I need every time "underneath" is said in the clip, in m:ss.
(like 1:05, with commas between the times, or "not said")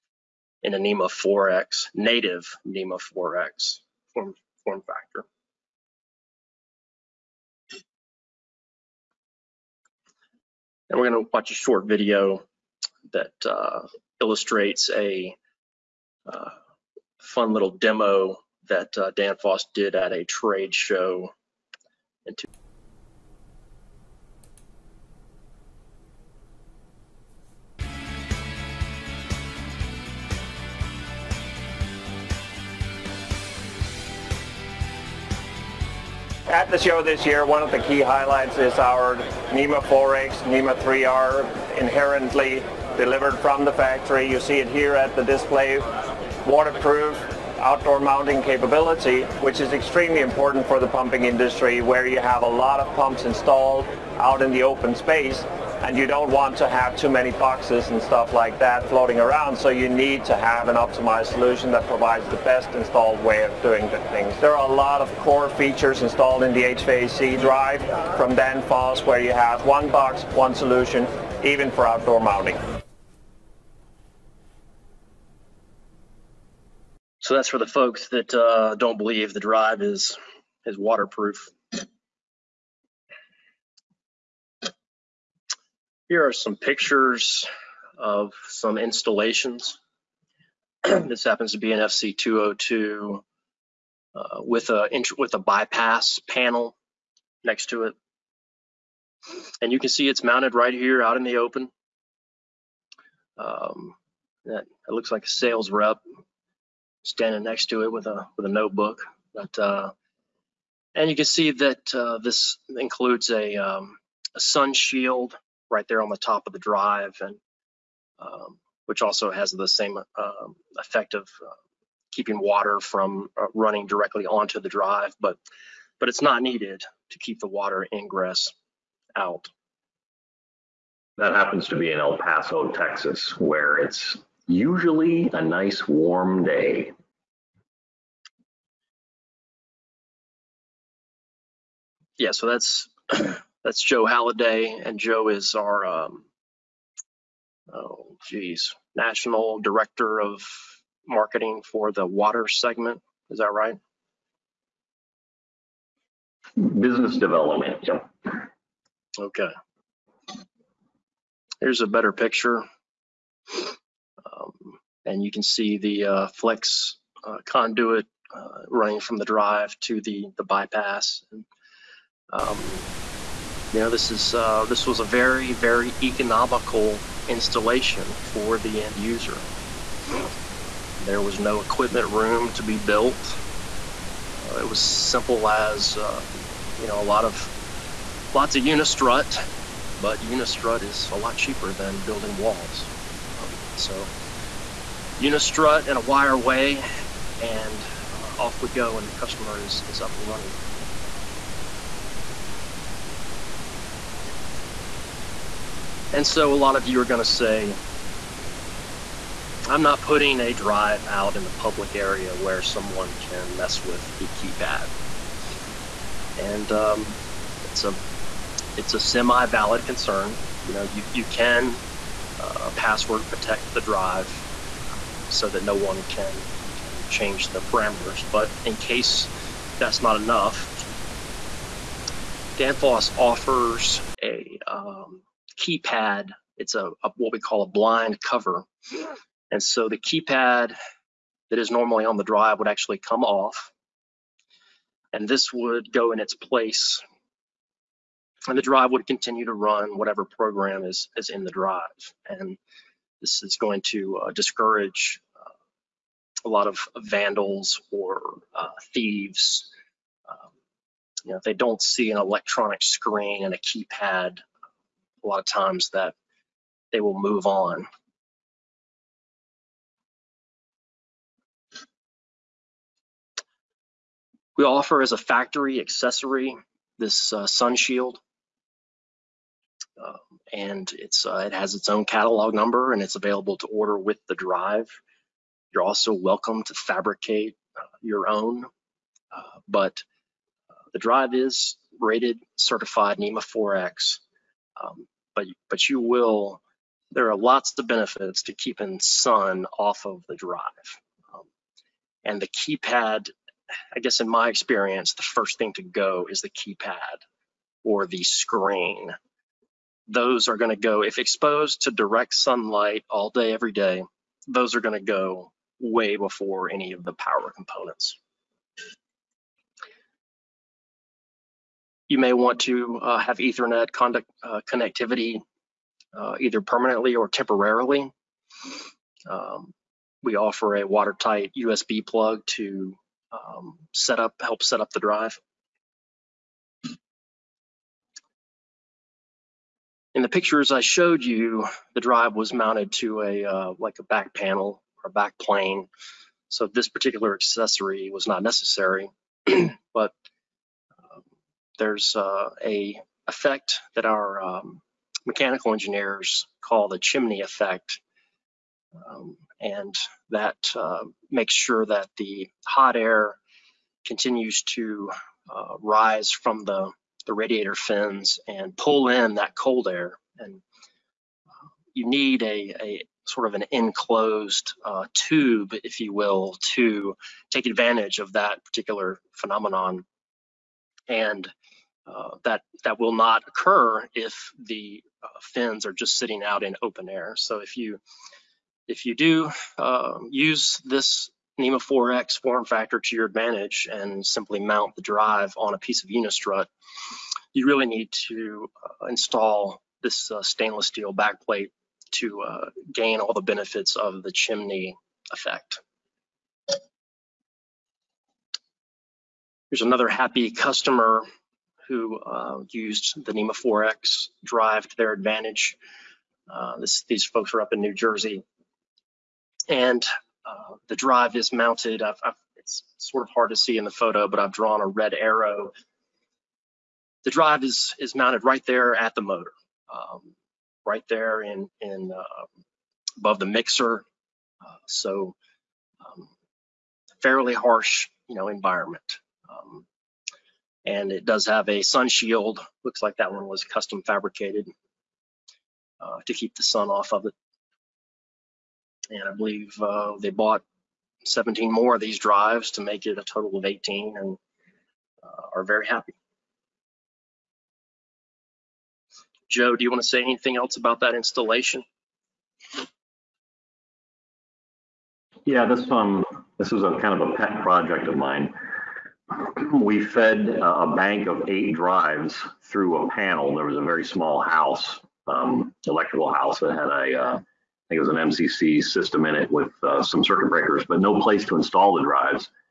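not said.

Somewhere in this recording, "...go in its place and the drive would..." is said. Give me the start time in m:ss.
4:05.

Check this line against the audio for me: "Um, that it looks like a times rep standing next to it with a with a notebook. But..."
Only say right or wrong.
wrong.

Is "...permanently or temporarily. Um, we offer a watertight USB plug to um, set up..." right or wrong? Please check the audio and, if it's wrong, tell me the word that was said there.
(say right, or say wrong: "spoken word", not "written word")
right.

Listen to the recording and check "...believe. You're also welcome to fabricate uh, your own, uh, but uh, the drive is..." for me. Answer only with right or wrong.
wrong.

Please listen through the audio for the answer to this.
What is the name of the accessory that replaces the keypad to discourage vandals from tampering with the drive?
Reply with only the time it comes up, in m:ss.
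3:57.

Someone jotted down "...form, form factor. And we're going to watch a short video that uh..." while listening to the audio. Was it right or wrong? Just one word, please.
right.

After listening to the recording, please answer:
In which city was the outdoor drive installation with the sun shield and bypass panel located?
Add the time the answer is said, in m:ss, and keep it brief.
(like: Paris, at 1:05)
El Paso, Texas, at 2:11.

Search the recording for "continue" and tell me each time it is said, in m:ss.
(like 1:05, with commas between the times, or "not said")
4:09, 6:04.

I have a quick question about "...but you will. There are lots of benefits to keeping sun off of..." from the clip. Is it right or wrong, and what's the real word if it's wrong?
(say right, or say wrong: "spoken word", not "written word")
right.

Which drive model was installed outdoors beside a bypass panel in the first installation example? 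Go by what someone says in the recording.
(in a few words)
FC202.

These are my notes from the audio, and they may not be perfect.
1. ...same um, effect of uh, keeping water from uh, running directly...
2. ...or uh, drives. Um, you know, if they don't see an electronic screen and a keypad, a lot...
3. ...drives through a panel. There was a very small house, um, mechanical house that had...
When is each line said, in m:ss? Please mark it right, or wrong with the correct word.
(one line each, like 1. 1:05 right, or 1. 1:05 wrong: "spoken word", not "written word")
1. 1:59 right
2. 4:17 wrong: "thieves", not "drives"
3. 7:51 wrong: "electrical", not "mechanical".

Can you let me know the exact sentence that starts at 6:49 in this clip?
Here's another happy customer who uh, used the NEMA 4X drive to their advantage.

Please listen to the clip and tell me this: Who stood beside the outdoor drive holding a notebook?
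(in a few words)
Joe Halliday.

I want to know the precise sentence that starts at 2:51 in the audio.
And, um, you know, this is uh, this was a very very economical installation for the end user.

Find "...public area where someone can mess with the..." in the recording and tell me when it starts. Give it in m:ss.
3:31.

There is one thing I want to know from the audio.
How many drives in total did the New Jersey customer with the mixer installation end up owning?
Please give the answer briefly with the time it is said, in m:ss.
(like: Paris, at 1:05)
18, at 7:33.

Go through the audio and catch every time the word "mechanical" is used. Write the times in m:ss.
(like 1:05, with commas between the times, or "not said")
5:55.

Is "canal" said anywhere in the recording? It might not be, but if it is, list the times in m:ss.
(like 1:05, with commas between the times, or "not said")
not said.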